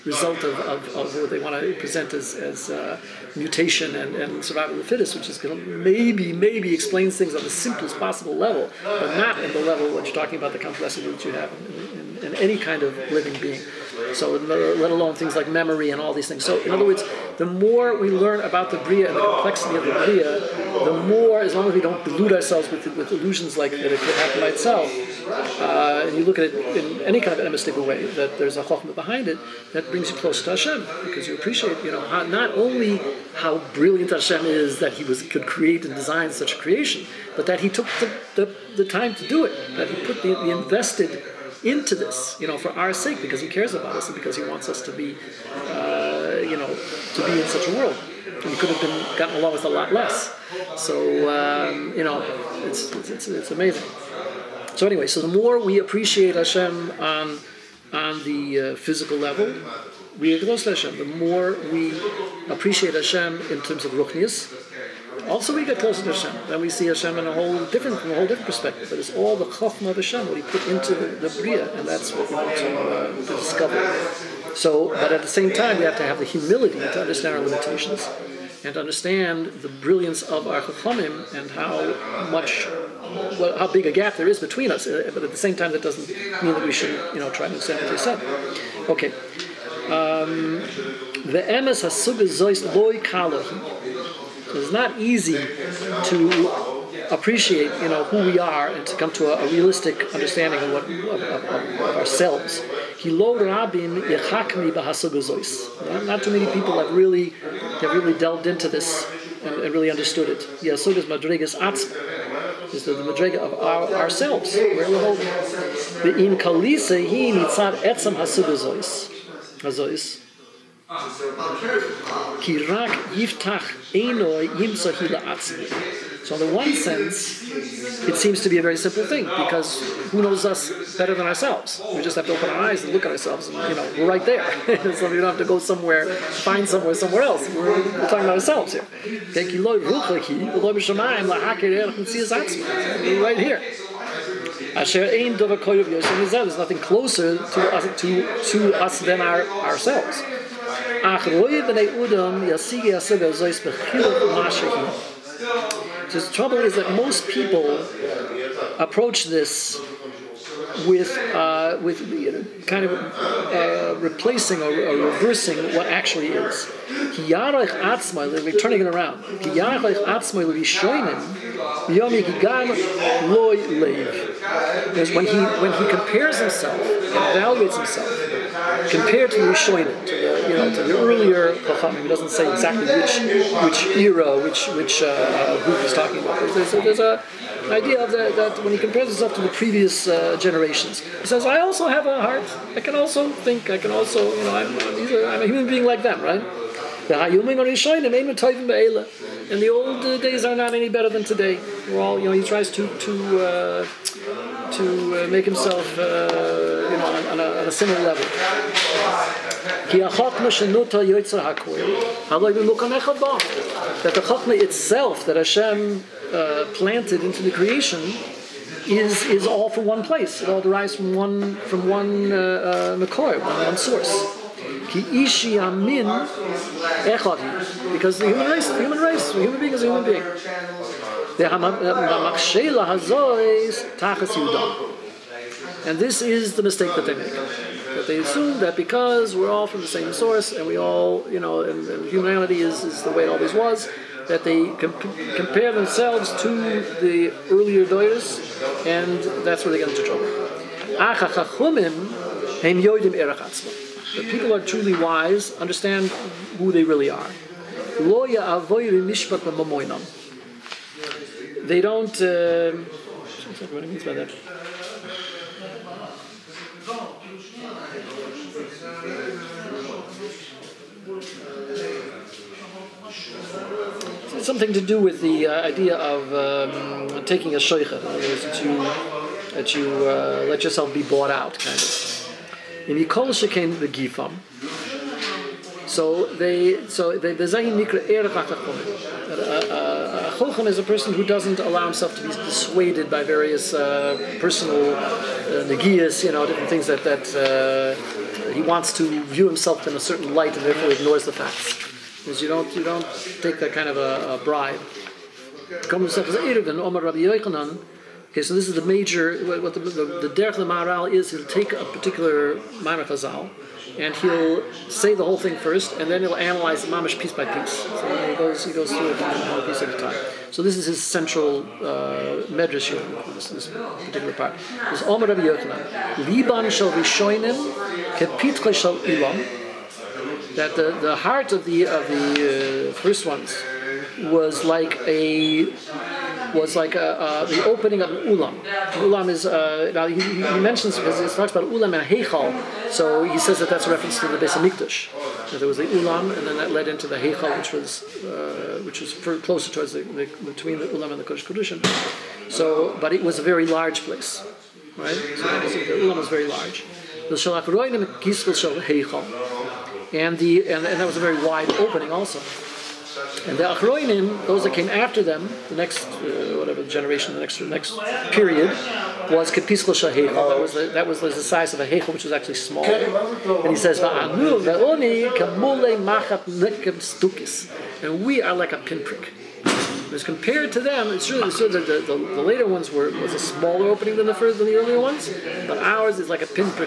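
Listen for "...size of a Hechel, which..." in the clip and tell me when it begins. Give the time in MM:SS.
06:11.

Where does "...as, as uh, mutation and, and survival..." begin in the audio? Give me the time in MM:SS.
00:02.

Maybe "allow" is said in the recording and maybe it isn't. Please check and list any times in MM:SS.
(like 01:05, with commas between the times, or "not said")
04:51.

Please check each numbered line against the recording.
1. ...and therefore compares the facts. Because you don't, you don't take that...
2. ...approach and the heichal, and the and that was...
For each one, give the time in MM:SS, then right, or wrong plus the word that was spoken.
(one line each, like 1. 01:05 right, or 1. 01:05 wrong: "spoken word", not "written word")
1. 05:00 wrong: "ignores", not "compares"
2. 05:57 wrong: "shalach", not "approach".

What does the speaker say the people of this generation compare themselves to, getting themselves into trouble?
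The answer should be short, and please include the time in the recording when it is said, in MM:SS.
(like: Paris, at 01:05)
the earlier doyers, at 04:07.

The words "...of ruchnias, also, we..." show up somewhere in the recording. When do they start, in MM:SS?
01:03.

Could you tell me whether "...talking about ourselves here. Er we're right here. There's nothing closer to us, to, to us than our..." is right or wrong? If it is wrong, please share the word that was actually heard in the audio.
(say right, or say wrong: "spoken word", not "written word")
right.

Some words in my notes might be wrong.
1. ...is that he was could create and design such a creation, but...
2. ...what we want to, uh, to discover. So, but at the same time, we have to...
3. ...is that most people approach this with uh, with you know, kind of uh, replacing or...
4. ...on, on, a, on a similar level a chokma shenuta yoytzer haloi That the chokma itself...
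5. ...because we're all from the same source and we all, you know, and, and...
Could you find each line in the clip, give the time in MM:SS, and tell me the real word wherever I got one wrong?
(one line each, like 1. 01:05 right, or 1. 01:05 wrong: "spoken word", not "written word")
1. 00:34 right
2. 01:12 right
3. 02:36 right
4. 03:27 right
5. 03:58 right.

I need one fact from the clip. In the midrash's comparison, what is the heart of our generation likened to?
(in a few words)
a pinprick.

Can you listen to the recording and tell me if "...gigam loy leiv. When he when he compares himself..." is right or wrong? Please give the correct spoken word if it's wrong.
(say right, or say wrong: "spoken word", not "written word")
right.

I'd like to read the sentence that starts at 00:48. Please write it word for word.
And could have been gotten along with a lot less.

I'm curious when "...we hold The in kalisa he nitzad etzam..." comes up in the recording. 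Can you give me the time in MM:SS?
01:54.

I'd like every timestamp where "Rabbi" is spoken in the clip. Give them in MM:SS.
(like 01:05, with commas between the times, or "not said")
05:25.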